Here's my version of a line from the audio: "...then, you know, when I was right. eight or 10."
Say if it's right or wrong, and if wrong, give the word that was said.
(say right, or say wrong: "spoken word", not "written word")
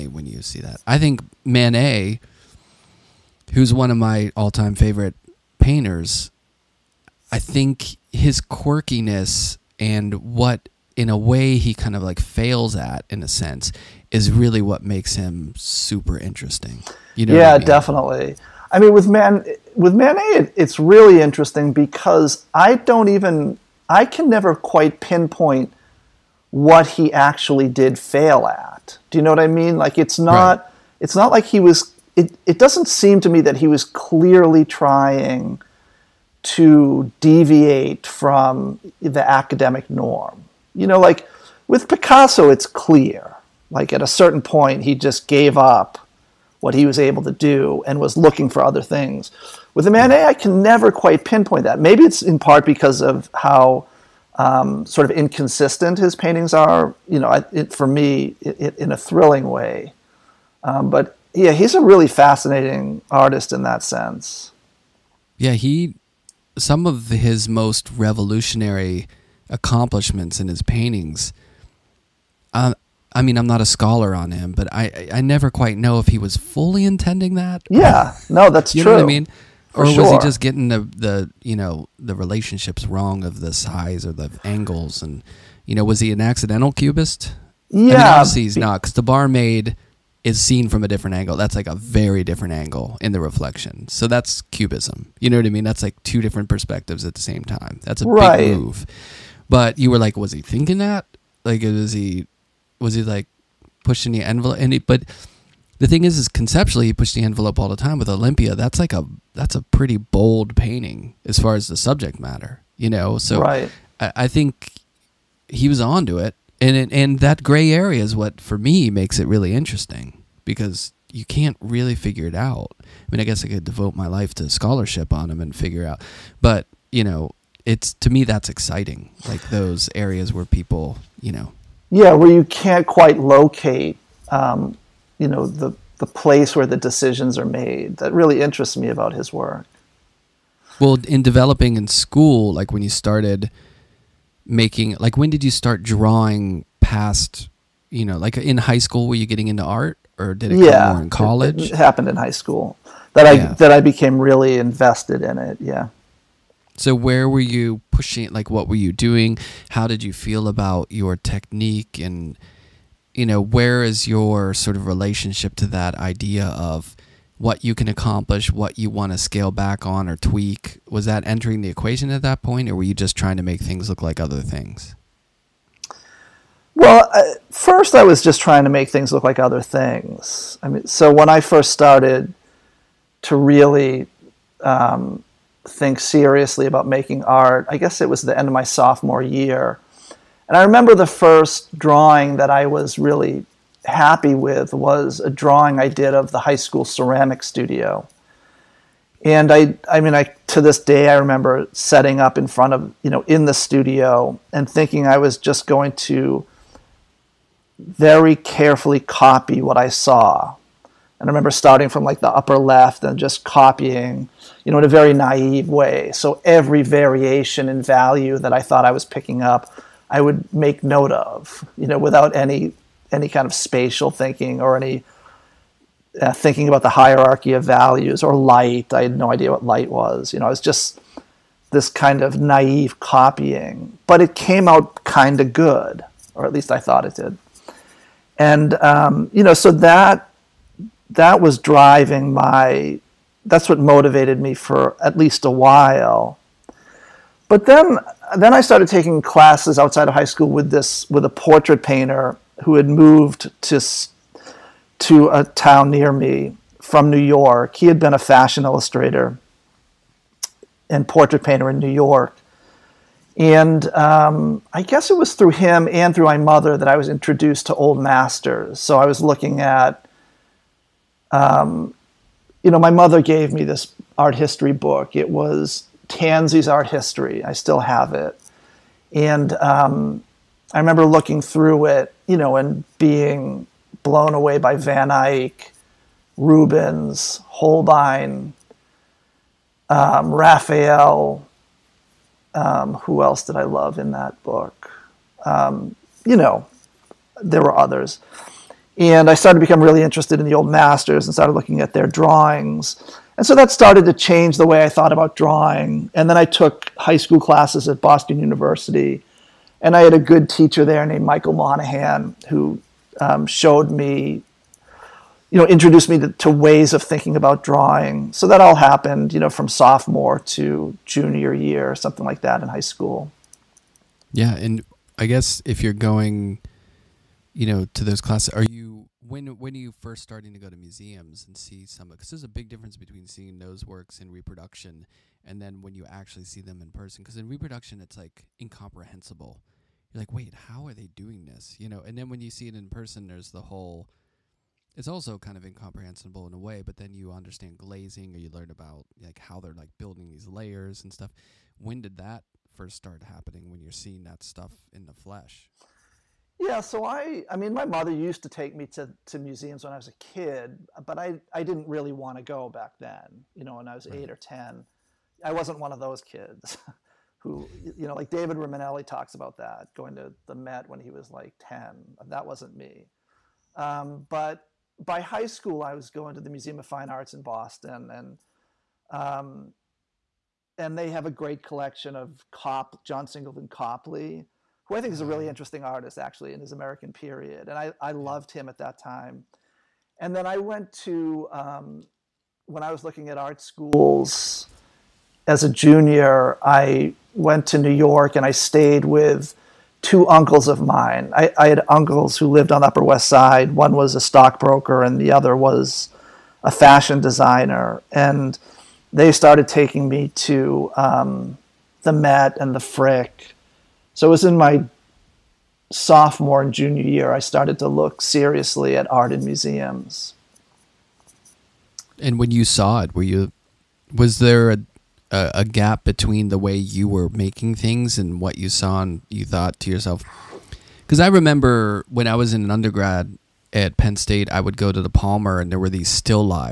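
right.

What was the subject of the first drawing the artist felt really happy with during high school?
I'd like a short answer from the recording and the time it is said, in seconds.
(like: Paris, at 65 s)
The high school ceramic studio, at 196 s.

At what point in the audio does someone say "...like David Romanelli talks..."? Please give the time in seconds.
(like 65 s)
368 s.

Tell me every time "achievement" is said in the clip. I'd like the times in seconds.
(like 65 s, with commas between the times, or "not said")
not said.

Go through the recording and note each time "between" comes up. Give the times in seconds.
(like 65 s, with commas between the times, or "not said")
332 s, 426 s.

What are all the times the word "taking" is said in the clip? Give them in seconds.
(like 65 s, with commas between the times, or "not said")
248 s, 409 s.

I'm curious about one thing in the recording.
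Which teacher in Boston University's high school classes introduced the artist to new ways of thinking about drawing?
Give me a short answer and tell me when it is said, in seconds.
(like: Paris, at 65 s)
Michael Monahan, at 311 s.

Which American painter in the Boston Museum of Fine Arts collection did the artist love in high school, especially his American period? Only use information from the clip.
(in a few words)
John Singleton Copley.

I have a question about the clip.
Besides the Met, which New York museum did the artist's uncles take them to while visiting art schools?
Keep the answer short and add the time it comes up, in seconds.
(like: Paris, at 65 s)
The Frick, at 412 s.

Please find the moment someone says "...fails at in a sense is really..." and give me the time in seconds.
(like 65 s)
12 s.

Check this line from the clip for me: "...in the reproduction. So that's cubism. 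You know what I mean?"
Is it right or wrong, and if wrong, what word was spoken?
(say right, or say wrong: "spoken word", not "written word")
wrong: "reflection", not "reproduction".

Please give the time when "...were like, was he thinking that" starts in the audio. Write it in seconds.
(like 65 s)
99 s.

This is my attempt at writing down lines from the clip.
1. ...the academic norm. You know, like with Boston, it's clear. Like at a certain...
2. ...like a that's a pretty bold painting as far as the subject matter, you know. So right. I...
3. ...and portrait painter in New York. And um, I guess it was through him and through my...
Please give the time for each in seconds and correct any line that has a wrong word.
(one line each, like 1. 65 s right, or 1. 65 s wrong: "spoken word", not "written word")
1. 39 s wrong: "Picasso", not "Boston"
2. 108 s right
3. 260 s right.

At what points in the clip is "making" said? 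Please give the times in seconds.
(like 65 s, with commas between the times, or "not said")
144 s, 186 s, 427 s.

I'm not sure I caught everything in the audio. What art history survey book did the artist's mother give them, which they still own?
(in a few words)
Janson's Art History.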